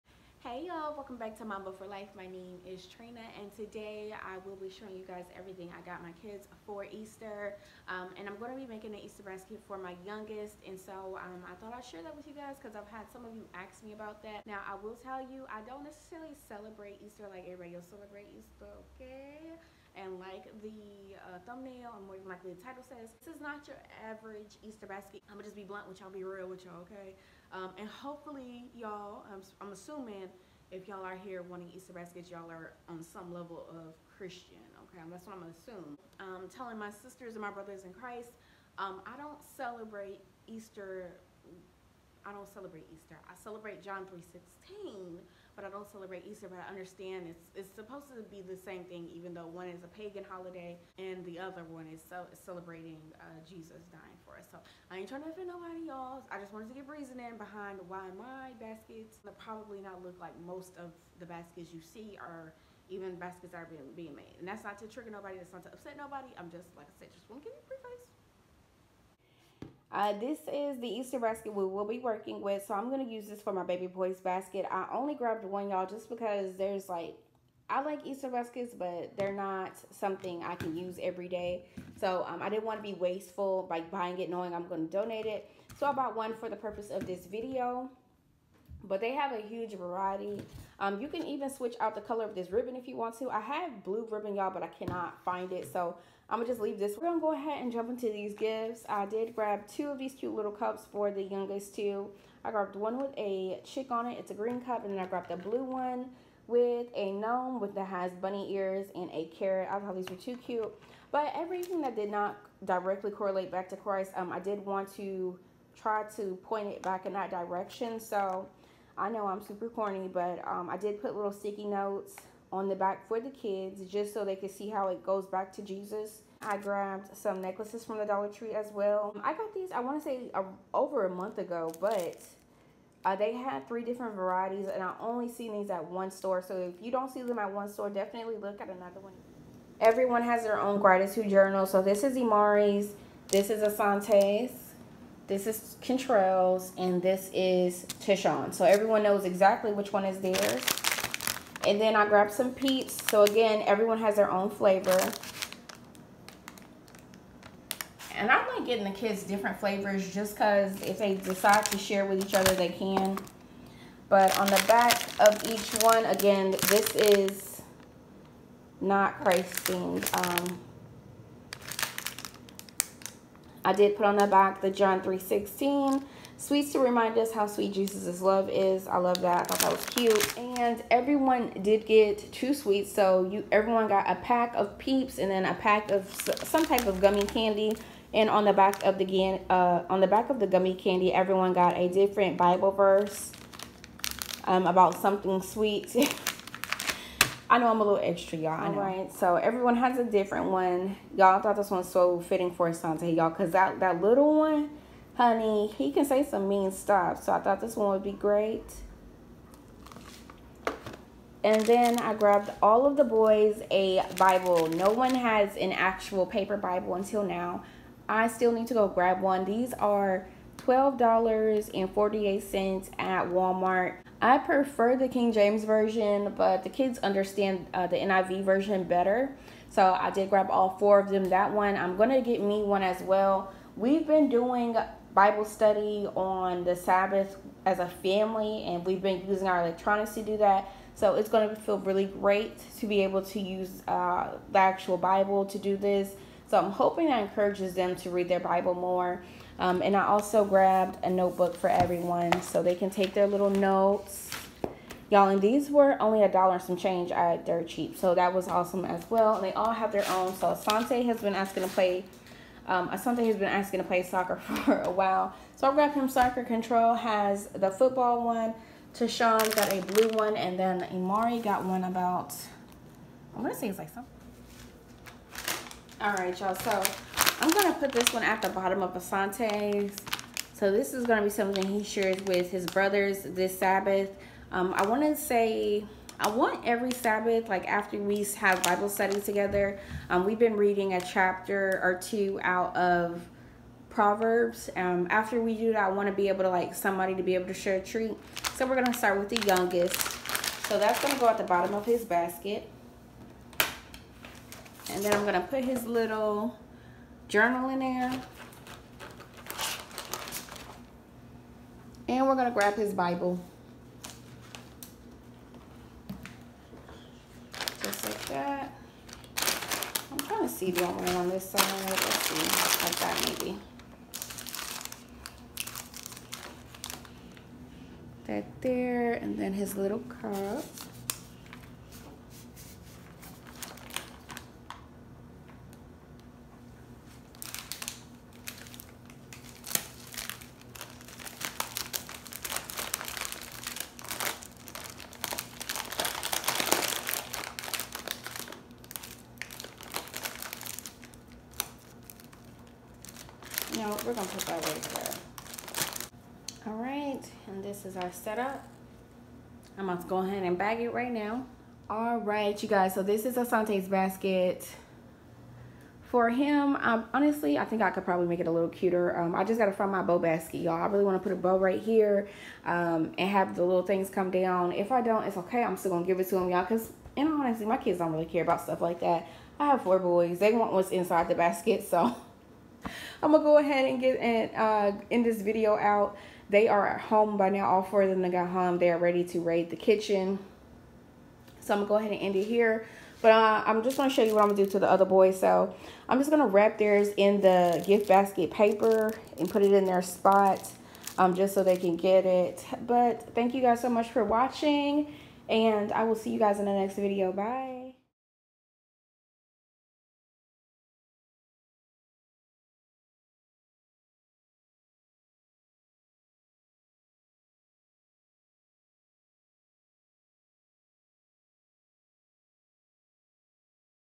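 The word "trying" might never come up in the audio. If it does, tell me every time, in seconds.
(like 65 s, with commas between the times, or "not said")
55 s, 320 s.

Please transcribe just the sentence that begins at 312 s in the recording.
And we're going to grab his Bible.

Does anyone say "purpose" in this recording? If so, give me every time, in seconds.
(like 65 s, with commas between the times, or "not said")
86 s.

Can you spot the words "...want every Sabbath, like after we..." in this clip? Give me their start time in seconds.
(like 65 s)
286 s.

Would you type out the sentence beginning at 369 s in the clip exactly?
Um, I just got to find my bow basket, y'all.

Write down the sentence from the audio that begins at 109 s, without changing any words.
I thought these were too cute.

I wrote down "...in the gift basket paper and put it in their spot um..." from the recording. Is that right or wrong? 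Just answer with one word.
right.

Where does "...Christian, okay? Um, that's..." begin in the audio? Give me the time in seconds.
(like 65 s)
34 s.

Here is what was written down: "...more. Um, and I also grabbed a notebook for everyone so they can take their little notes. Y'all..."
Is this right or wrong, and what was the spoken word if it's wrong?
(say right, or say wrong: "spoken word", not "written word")
right.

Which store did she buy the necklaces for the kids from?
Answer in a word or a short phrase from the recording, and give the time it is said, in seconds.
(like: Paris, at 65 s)
Dollar Tree, at 128 s.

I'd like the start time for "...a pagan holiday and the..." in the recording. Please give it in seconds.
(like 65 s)
49 s.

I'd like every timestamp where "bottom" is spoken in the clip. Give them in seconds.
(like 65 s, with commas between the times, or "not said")
278 s, 301 s.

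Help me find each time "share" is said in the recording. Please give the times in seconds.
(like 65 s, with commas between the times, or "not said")
11 s, 161 s, 281 s, 297 s.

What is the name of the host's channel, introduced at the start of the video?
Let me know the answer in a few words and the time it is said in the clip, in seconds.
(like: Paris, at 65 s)
Mamba for life, at 1 s.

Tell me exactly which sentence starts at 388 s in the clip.
They are ready to raid the kitchen.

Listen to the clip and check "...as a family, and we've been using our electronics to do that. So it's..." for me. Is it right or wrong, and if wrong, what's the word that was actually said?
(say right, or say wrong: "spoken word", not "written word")
right.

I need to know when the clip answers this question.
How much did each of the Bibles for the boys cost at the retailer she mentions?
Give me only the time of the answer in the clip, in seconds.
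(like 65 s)
220 s.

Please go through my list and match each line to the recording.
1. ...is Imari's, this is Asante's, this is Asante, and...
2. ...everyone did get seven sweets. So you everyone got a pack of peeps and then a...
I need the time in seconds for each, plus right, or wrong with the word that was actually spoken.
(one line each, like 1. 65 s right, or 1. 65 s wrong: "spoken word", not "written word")
1. 142 s wrong: "Contrails", not "Asante"
2. 180 s wrong: "two", not "seven".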